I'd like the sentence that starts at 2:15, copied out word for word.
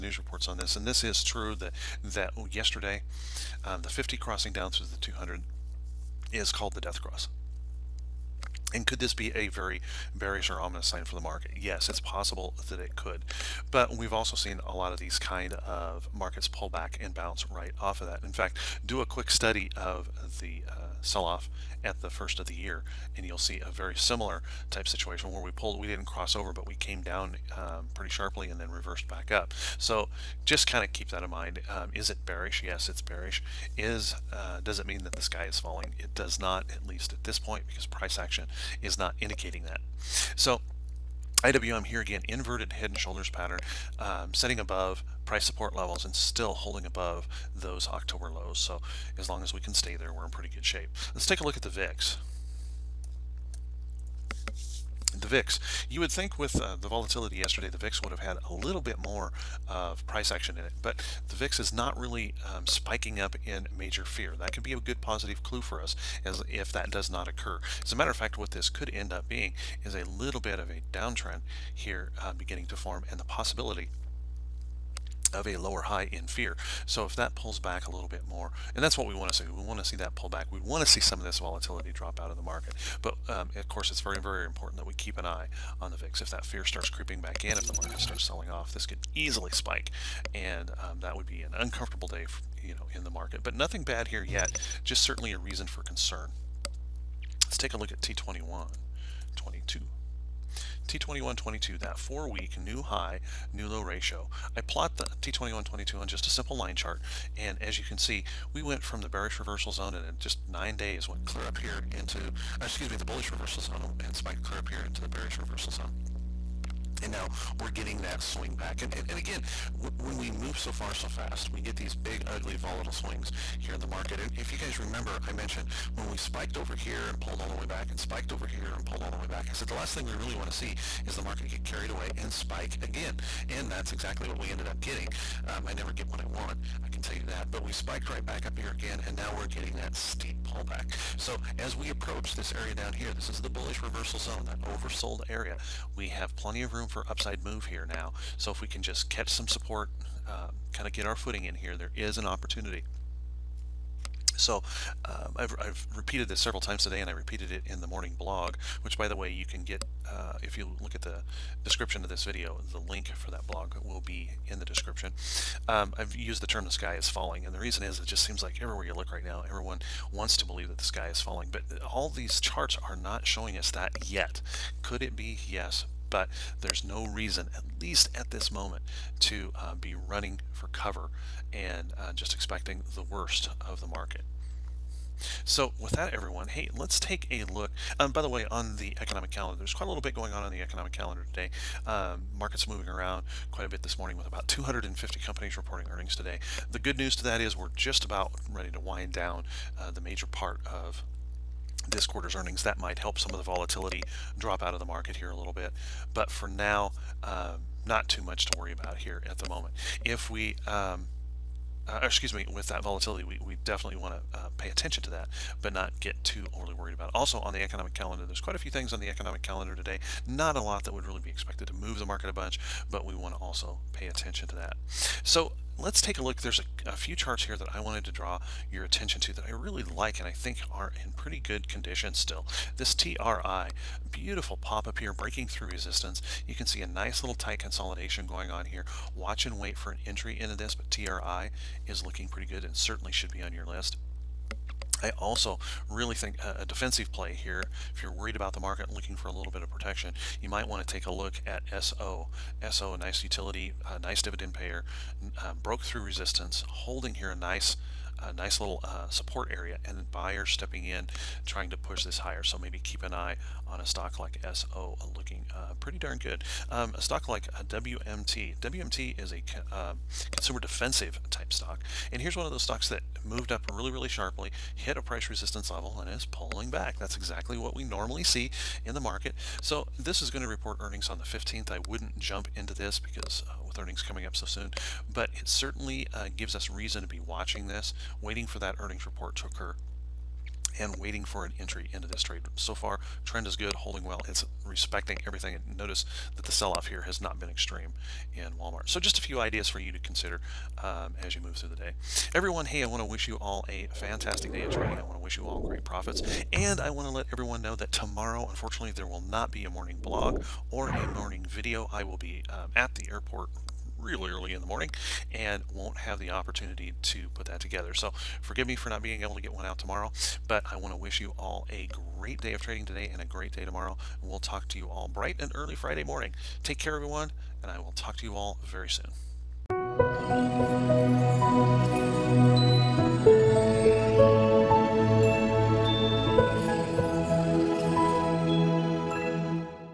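Um, I never get what I want.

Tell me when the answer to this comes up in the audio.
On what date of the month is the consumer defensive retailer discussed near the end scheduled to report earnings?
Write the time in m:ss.
4:41.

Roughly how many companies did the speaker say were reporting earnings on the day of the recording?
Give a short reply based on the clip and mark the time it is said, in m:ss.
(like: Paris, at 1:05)
250, at 3:14.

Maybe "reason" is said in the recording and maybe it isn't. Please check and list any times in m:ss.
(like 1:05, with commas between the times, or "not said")
1:35, 2:47, 2:57, 4:46.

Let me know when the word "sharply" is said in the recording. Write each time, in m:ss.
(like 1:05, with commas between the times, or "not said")
0:28, 4:34.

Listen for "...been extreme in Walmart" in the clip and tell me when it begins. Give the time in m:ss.
4:57.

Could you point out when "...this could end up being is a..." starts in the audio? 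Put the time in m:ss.
1:08.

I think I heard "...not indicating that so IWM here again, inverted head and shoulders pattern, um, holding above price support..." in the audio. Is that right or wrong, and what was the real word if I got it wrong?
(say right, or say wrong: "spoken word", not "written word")
wrong: "setting", not "holding".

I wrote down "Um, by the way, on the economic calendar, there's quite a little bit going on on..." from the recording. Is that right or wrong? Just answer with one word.
right.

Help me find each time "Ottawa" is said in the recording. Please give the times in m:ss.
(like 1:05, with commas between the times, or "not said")
not said.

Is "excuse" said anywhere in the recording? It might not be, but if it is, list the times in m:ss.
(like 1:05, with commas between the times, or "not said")
1:52, 3:32.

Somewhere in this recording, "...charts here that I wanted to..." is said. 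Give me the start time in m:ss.
3:47.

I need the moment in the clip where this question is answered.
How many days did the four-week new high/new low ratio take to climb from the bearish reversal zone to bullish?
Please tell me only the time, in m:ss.
1:50.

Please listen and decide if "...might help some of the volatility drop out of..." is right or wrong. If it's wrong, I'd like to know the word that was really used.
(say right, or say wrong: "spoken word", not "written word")
right.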